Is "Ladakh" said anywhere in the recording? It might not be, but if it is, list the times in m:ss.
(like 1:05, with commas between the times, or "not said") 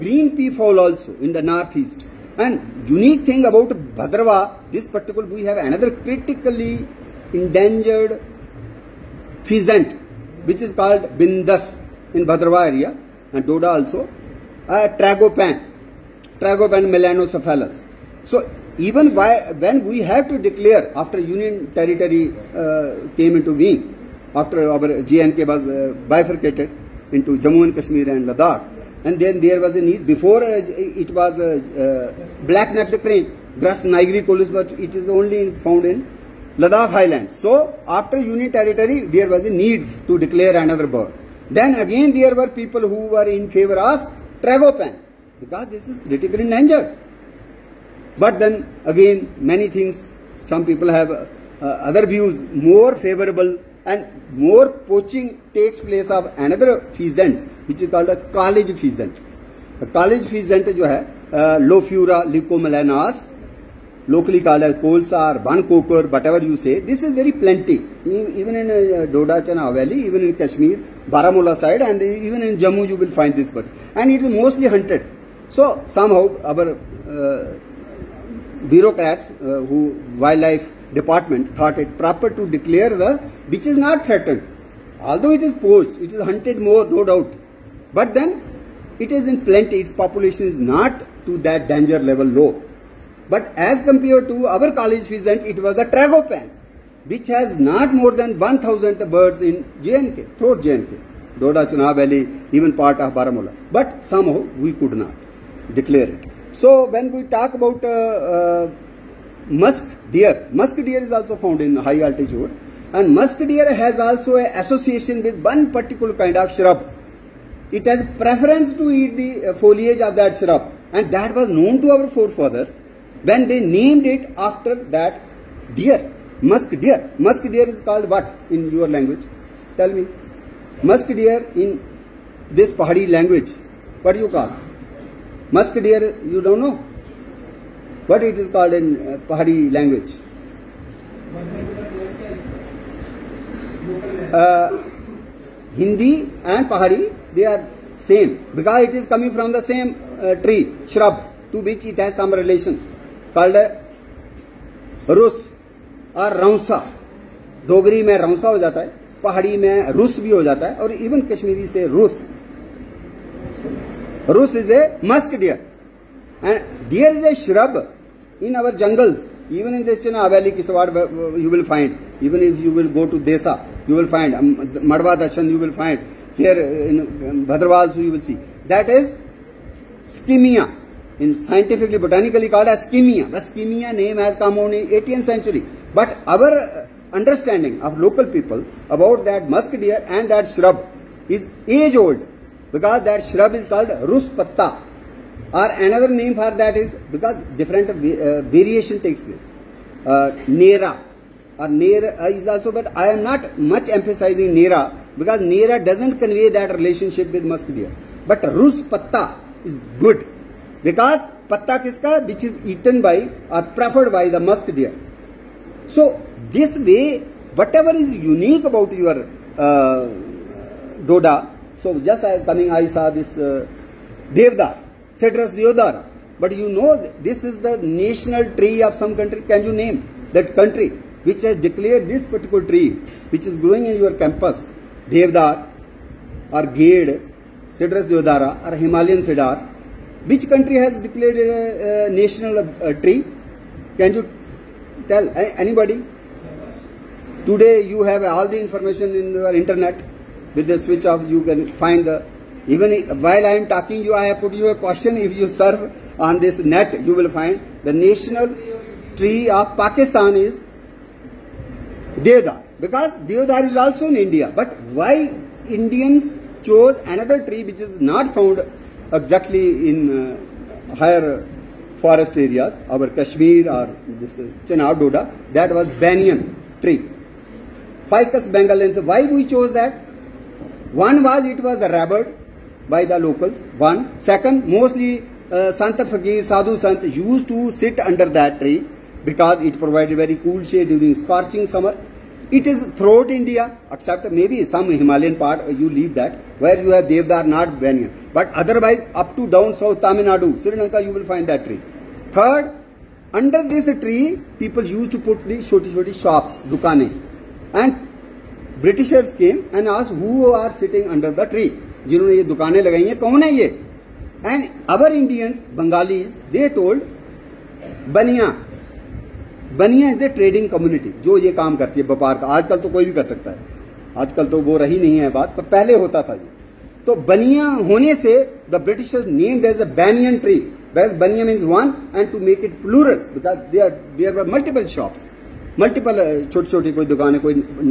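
0:28, 0:36.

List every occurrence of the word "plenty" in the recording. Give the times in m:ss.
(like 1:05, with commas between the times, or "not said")
1:07, 1:29.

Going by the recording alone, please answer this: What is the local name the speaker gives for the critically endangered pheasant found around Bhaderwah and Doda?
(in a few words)
bindas.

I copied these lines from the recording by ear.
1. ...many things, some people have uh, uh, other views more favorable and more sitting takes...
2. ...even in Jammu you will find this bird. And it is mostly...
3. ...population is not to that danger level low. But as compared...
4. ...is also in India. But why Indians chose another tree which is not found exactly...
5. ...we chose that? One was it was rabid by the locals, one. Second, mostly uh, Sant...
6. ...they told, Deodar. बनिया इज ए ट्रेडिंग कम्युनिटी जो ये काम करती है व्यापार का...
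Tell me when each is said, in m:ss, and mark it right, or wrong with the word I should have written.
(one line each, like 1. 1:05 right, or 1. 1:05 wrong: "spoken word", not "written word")
1. 0:49 wrong: "poaching", not "sitting"
2. 1:12 right
3. 1:29 right
4. 4:23 right
5. 4:39 right
6. 5:16 wrong: "Banyan", not "Deodar".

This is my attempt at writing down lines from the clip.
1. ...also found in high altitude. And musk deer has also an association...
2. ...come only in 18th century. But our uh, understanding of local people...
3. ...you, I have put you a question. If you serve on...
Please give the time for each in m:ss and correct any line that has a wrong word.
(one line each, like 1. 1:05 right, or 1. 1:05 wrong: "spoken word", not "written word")
1. 1:51 right
2. 3:04 right
3. 4:14 right.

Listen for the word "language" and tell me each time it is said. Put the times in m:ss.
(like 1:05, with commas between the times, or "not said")
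2:08, 2:13, 2:19.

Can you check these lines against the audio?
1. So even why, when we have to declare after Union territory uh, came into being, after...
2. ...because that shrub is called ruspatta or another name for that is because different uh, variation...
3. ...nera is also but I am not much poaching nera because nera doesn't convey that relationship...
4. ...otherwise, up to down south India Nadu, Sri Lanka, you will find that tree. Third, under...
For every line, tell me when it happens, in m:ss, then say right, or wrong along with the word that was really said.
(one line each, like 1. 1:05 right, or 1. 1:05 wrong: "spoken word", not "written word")
1. 0:18 right
2. 3:12 right
3. 3:21 wrong: "emphasizing", not "poaching"
4. 4:58 wrong: "Tamil", not "India".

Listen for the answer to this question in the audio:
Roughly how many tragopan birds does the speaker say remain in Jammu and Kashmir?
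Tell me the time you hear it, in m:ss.
1:38.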